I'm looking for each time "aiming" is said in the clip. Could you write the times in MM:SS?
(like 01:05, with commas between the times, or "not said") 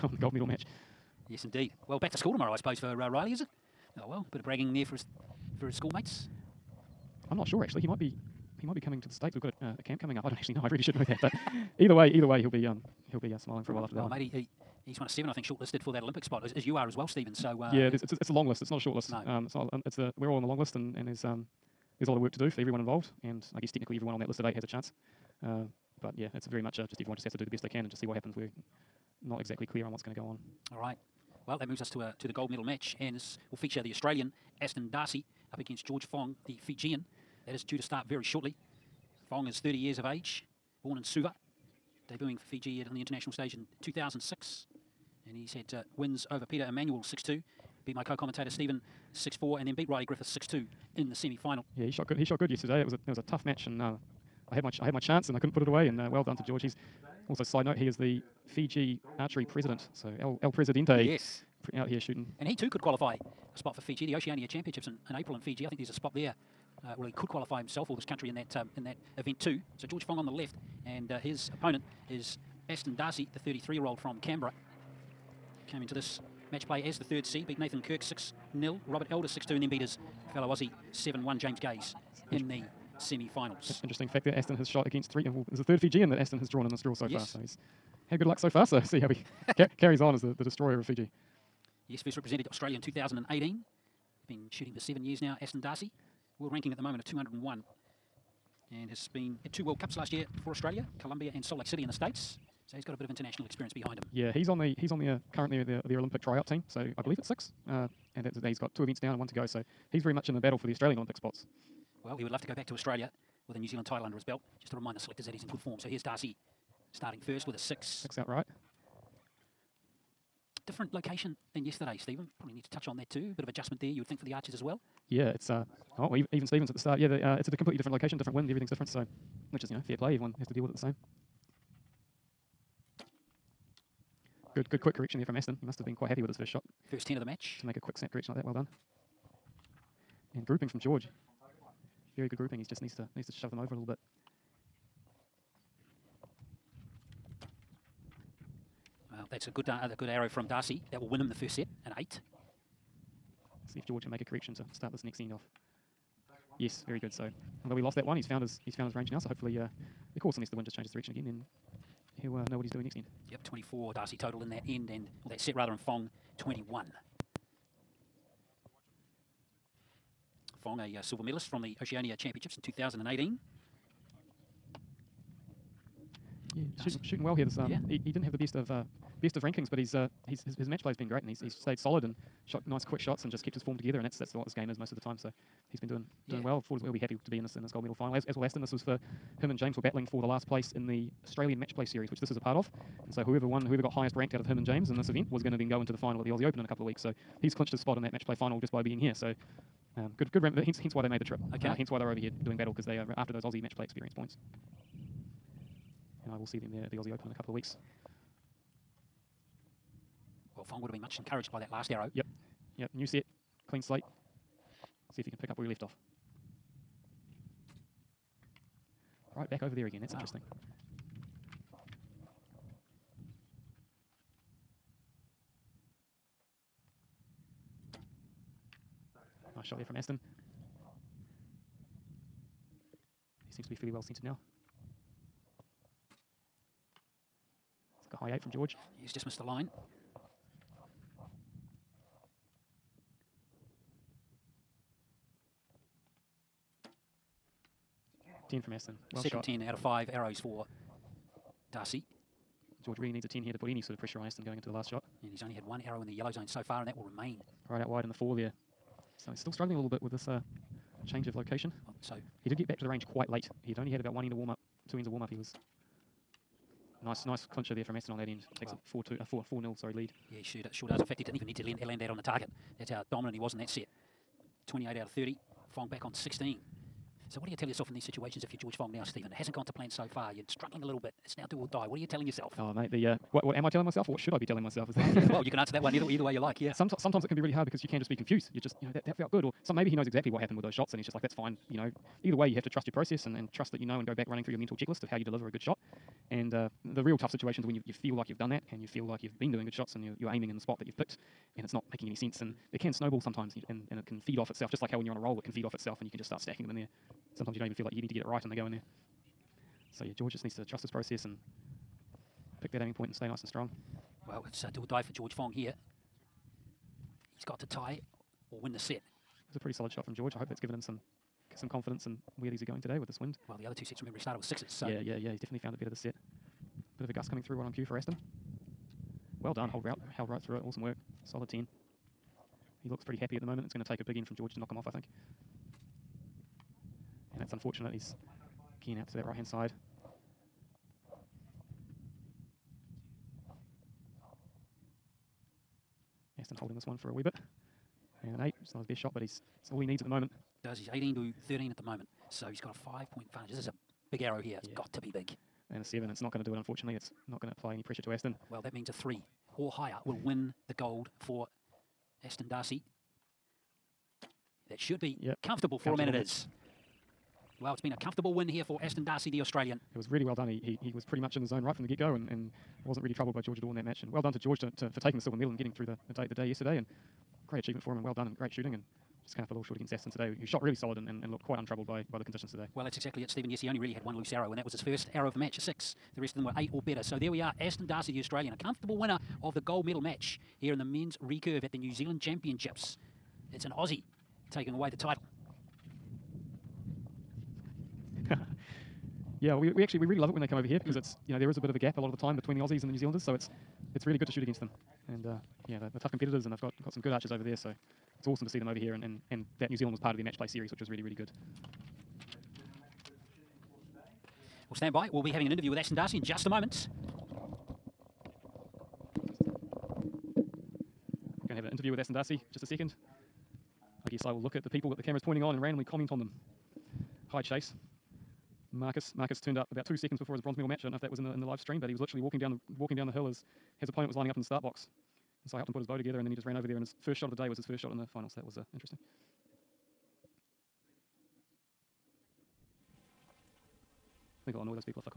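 05:00, 05:12.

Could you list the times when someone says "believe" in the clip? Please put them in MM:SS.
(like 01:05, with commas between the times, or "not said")
01:47.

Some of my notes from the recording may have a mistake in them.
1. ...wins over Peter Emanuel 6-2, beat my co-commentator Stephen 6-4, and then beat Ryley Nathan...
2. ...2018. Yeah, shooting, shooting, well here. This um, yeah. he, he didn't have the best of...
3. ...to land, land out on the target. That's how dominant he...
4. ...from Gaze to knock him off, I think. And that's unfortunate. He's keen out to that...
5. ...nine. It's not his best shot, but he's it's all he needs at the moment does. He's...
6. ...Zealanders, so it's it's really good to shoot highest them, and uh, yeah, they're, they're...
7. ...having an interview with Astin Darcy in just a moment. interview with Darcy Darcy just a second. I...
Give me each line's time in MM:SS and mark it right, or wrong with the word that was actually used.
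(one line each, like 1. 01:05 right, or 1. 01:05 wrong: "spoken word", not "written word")
1. 00:45 wrong: "Griffiths", not "Nathan"
2. 02:52 right
3. 04:31 right
4. 05:34 wrong: "George", not "Gaze"
5. 05:48 wrong: "eight", not "nine"
6. 06:42 wrong: "against", not "highest"
7. 06:55 wrong: "Astin", not "Darcy".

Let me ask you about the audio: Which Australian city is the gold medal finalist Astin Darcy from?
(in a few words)
Canberra.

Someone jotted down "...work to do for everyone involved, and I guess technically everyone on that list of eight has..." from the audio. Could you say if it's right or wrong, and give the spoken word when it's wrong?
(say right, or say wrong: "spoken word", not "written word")
right.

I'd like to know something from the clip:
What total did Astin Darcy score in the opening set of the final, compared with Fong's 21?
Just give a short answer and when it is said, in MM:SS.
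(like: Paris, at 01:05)
24, at 02:43.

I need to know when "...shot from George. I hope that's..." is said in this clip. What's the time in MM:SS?
05:19.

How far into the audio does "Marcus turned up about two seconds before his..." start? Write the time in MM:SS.
07:09.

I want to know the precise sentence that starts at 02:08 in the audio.
So, which is you know fair play.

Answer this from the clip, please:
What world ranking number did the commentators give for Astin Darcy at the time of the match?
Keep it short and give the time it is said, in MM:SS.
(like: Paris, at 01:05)
201, at 01:37.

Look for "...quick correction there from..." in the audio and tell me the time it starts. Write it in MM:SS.
02:14.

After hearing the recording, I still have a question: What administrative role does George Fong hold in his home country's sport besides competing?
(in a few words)
Fiji archery president.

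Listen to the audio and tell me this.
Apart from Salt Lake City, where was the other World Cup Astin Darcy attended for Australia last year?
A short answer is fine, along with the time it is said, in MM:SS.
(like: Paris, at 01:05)
Colombia, at 01:40.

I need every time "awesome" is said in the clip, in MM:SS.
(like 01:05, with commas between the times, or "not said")
05:30, 06:48.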